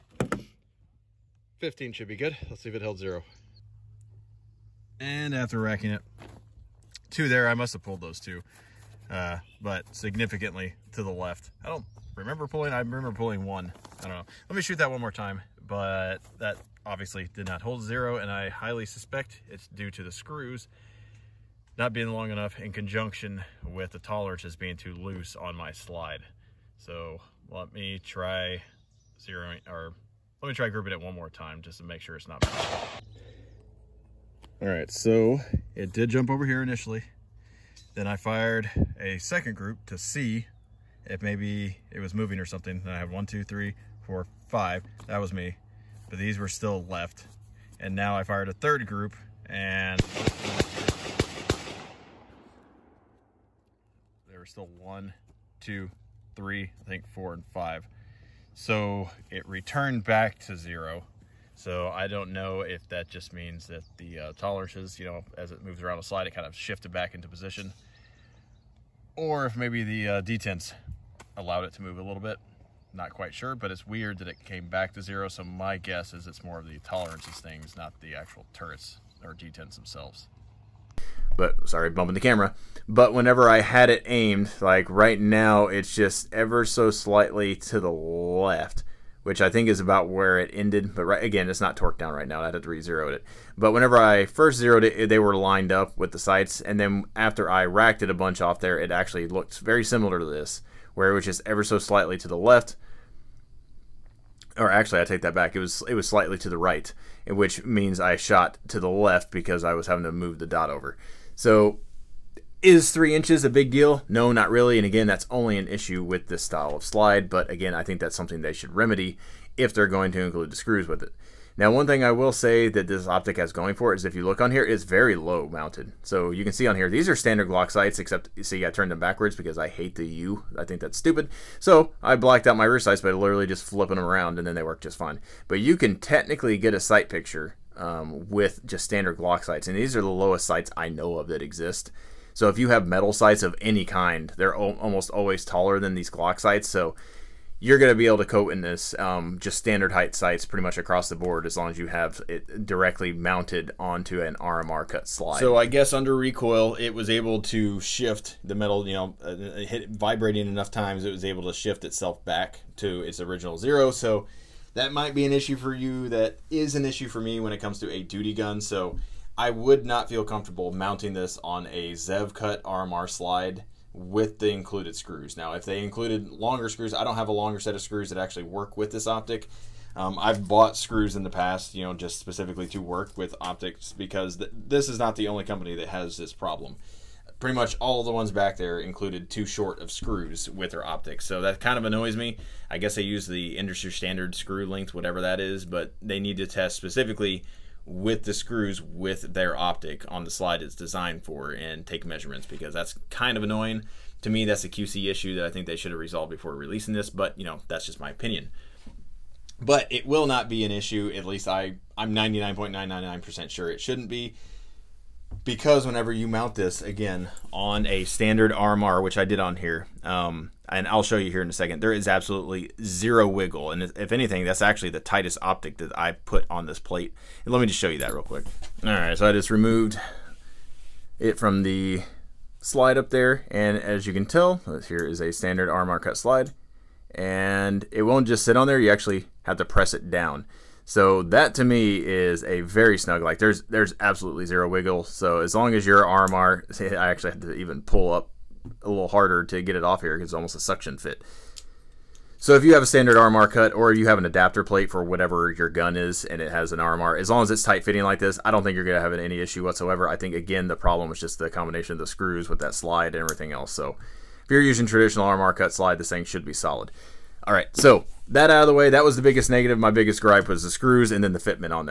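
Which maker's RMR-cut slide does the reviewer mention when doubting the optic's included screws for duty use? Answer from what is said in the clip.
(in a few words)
Zev.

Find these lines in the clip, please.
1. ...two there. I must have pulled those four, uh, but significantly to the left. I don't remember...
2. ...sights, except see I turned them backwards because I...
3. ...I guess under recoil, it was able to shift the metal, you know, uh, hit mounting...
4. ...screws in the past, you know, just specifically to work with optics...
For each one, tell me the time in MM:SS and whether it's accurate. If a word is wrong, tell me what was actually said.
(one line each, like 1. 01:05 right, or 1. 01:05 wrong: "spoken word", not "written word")
1. 00:07 wrong: "two", not "four"
2. 02:07 right
3. 02:35 wrong: "vibrating", not "mounting"
4. 03:00 right.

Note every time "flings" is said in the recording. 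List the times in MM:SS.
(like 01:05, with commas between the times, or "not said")
not said.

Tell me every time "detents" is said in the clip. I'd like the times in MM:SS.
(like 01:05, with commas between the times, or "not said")
01:10, 01:19.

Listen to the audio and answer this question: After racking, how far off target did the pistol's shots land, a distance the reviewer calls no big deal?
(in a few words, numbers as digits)
3 inches.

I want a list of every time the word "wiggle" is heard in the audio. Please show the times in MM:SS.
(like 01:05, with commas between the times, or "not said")
03:43, 04:04.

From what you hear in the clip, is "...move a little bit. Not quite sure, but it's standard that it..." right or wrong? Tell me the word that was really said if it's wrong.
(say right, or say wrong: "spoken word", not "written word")
wrong: "weird", not "standard".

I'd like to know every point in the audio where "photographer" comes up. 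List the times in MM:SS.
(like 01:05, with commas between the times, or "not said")
not said.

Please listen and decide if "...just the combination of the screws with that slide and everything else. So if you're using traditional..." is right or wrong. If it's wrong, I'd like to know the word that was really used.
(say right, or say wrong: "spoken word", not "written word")
right.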